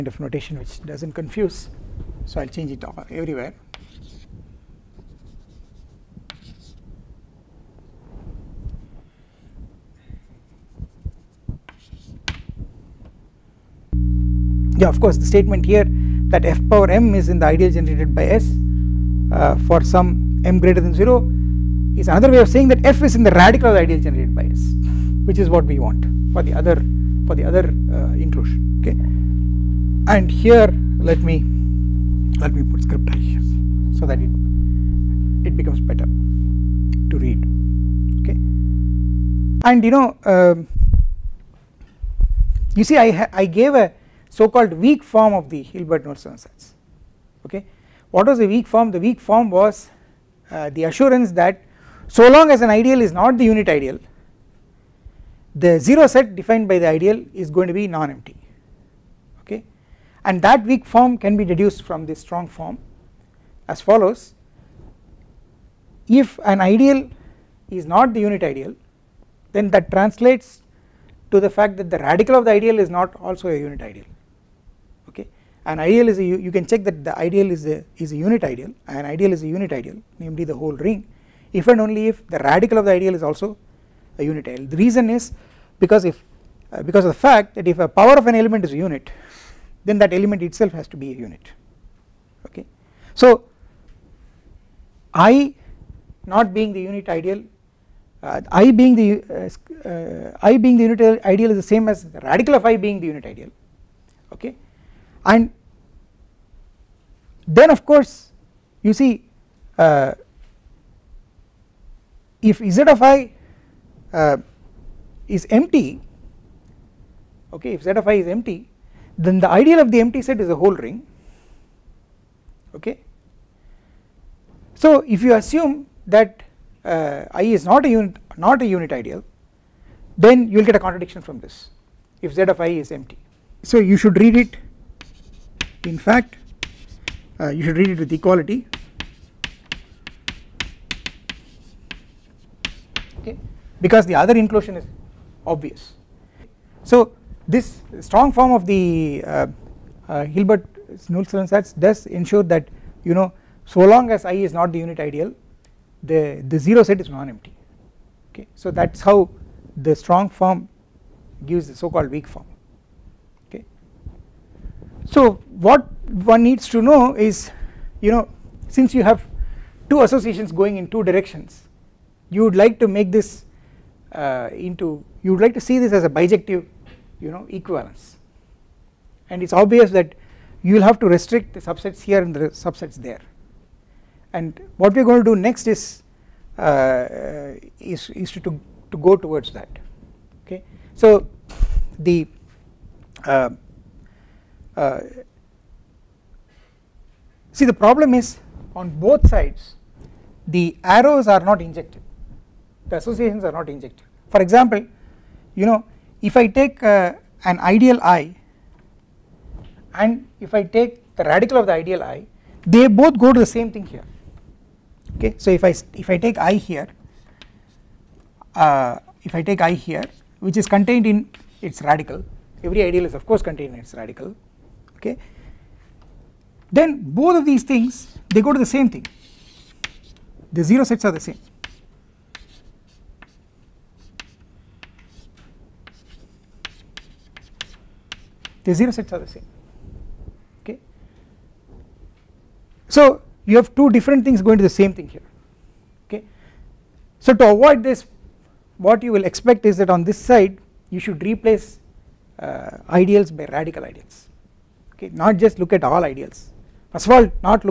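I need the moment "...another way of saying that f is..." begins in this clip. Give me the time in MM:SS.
00:22.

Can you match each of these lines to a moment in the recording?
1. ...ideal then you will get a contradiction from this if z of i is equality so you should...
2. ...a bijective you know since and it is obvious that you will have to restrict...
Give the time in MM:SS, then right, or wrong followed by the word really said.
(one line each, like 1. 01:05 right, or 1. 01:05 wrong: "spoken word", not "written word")
1. 02:08 wrong: "empty", not "equality"
2. 02:56 wrong: "equivalence", not "since".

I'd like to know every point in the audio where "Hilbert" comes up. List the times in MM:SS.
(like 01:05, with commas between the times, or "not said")
00:45, 02:30.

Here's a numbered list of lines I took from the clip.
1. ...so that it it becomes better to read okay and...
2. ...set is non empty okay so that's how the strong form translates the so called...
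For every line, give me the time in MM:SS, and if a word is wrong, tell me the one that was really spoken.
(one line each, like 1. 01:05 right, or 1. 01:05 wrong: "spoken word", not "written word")
1. 00:33 right
2. 02:36 wrong: "gives", not "translates".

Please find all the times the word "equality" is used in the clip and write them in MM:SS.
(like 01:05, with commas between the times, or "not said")
02:18.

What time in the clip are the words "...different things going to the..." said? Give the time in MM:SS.
04:03.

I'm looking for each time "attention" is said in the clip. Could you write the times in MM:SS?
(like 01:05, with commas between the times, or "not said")
not said.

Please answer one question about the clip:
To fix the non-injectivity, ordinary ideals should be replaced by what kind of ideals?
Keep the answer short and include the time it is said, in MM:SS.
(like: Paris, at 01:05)
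radical ideals, at 04:13.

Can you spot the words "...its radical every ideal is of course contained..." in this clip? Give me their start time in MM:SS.
03:41.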